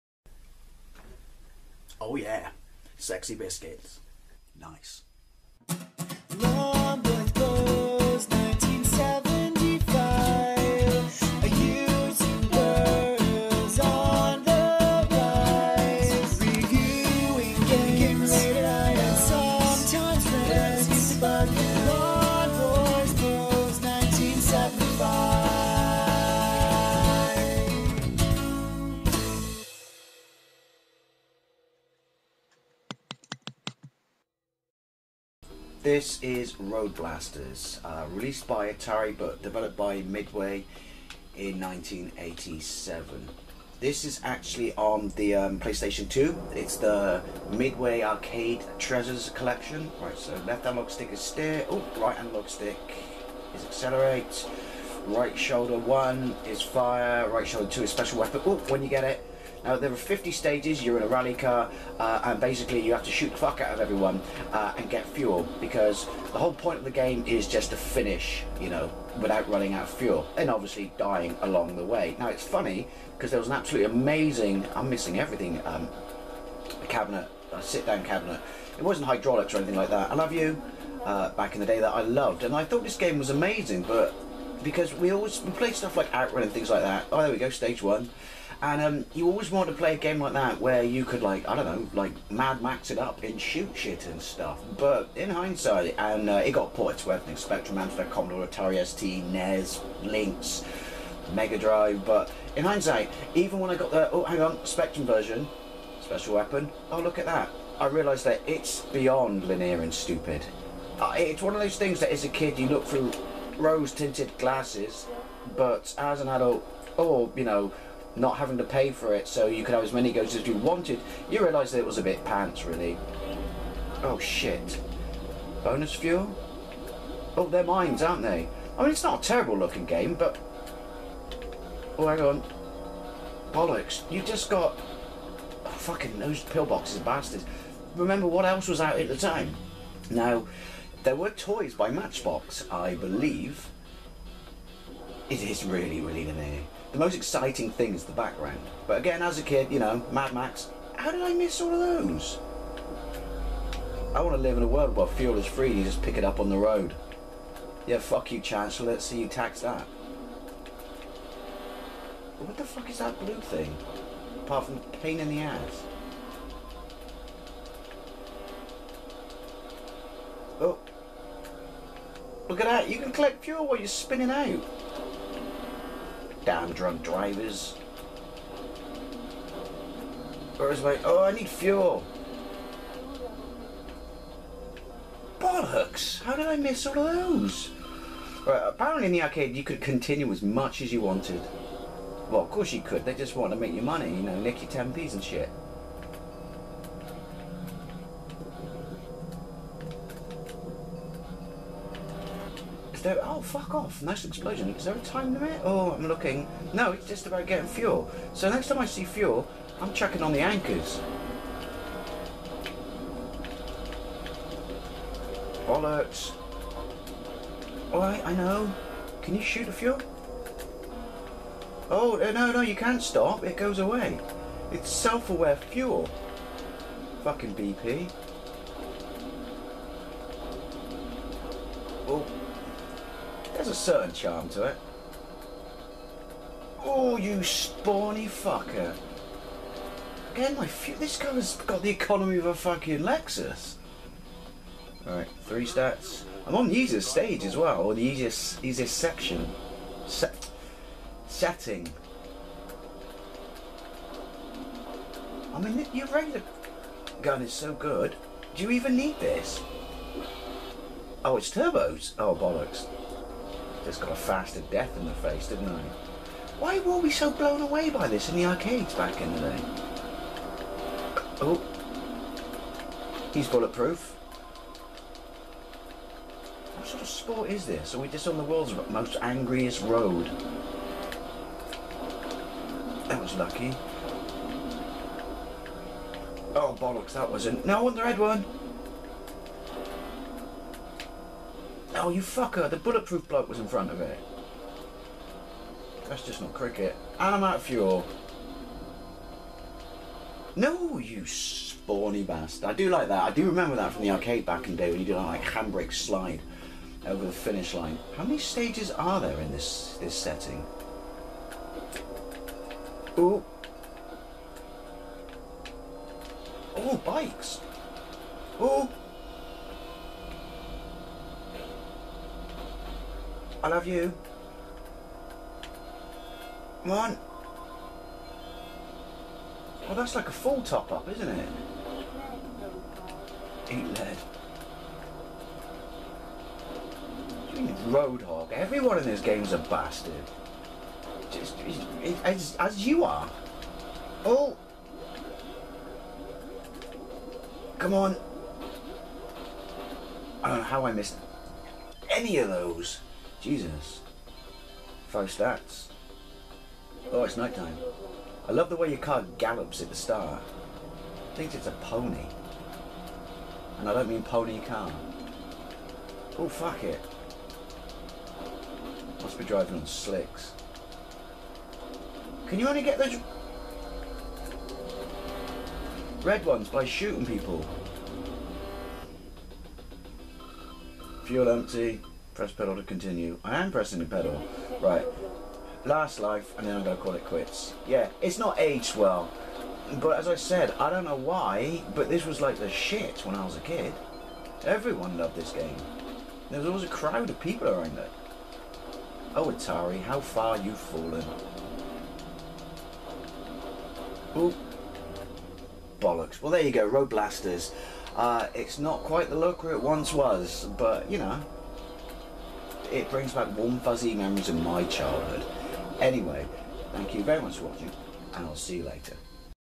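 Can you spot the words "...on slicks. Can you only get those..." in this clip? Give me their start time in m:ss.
6:09.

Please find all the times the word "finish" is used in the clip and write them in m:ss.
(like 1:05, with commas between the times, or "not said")
1:07, 5:07.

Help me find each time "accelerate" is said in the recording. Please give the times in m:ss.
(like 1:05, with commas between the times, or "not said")
0:53.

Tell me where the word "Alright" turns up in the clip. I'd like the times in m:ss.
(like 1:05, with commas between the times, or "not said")
3:37, 4:05.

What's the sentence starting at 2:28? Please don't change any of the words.
But again, as a kid, you know, Mad Max, how did I miss all of those?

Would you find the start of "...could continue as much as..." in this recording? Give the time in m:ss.
3:09.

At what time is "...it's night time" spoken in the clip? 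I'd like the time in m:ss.
5:57.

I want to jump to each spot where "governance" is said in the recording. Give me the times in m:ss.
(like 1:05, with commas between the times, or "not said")
not said.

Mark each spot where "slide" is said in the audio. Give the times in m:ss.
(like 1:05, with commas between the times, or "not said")
5:05.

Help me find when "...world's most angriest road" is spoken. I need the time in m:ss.
4:38.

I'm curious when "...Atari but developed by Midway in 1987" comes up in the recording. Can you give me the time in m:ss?
0:38.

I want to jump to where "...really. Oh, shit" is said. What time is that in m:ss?
2:02.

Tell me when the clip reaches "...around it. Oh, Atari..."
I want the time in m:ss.
6:37.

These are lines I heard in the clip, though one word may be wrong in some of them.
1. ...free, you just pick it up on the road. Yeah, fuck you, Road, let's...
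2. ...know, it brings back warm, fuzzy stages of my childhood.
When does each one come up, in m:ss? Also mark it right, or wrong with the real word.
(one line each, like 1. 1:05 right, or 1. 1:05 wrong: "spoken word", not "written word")
1. 2:35 wrong: "Chancellor", not "Road"
2. 6:51 wrong: "memories", not "stages".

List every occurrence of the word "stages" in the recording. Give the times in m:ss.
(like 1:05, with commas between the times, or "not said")
1:00, 1:27, 4:07, 5:08.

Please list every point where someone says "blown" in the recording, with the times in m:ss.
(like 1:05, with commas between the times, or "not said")
4:27.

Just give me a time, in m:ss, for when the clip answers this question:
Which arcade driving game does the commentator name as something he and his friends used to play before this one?
1:26.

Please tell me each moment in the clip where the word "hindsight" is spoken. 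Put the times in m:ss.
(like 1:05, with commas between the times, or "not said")
1:35, 1:42.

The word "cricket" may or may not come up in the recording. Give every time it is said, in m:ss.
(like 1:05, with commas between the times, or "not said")
4:56.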